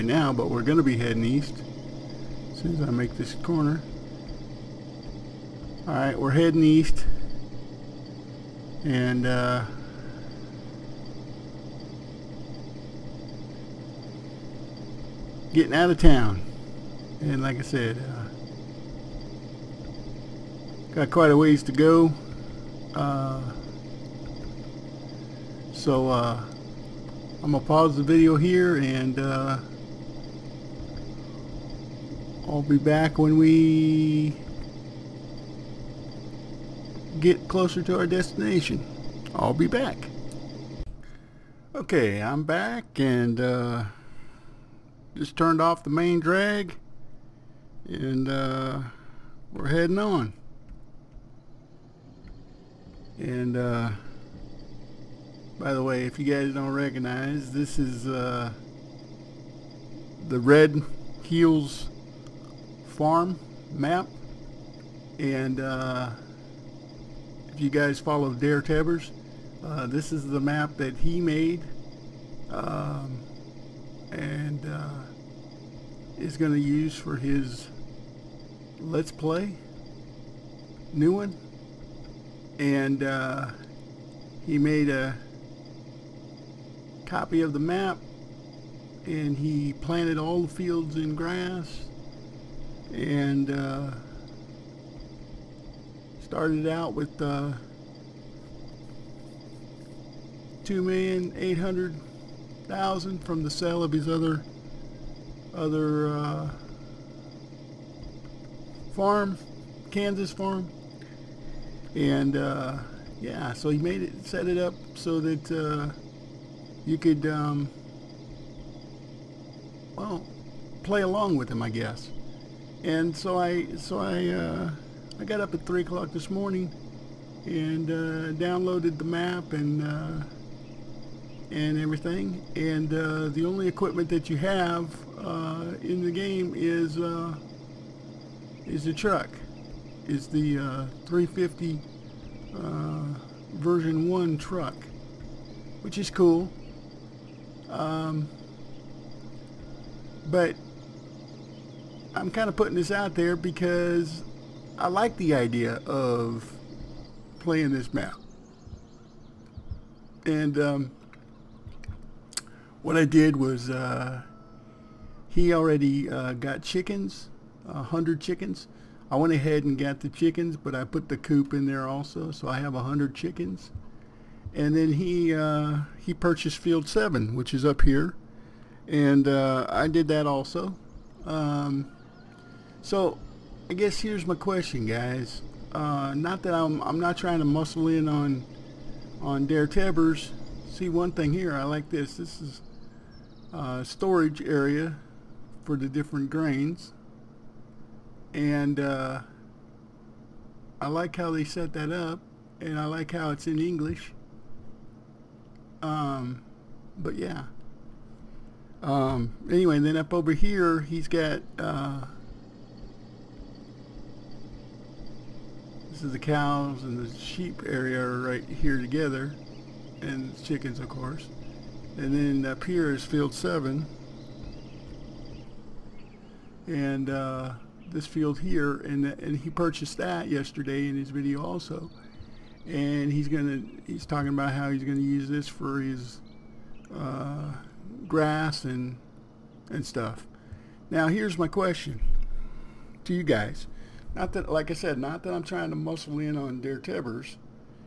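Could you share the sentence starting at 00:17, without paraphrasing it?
And like I said, uh, got quite a ways to go.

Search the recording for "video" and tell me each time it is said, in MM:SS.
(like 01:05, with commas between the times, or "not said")
00:28, 03:51.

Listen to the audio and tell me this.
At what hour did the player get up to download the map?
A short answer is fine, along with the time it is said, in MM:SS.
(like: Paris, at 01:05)
3 o'clock, at 02:05.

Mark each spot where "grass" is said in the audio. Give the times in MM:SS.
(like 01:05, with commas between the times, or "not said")
01:31, 03:58.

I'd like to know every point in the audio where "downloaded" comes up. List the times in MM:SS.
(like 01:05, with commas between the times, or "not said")
02:08.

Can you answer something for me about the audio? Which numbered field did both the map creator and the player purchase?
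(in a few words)
Field 7.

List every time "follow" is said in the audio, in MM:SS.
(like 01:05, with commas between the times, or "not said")
01:07.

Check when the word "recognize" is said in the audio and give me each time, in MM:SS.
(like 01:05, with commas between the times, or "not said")
00:56.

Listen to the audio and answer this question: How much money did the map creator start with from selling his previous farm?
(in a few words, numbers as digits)
2,800,000.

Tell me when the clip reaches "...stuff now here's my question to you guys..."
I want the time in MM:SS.
03:59.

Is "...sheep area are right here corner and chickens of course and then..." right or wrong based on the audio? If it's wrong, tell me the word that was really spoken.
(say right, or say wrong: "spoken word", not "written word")
wrong: "together", not "corner".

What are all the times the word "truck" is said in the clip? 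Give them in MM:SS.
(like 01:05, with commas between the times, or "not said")
02:18, 02:24.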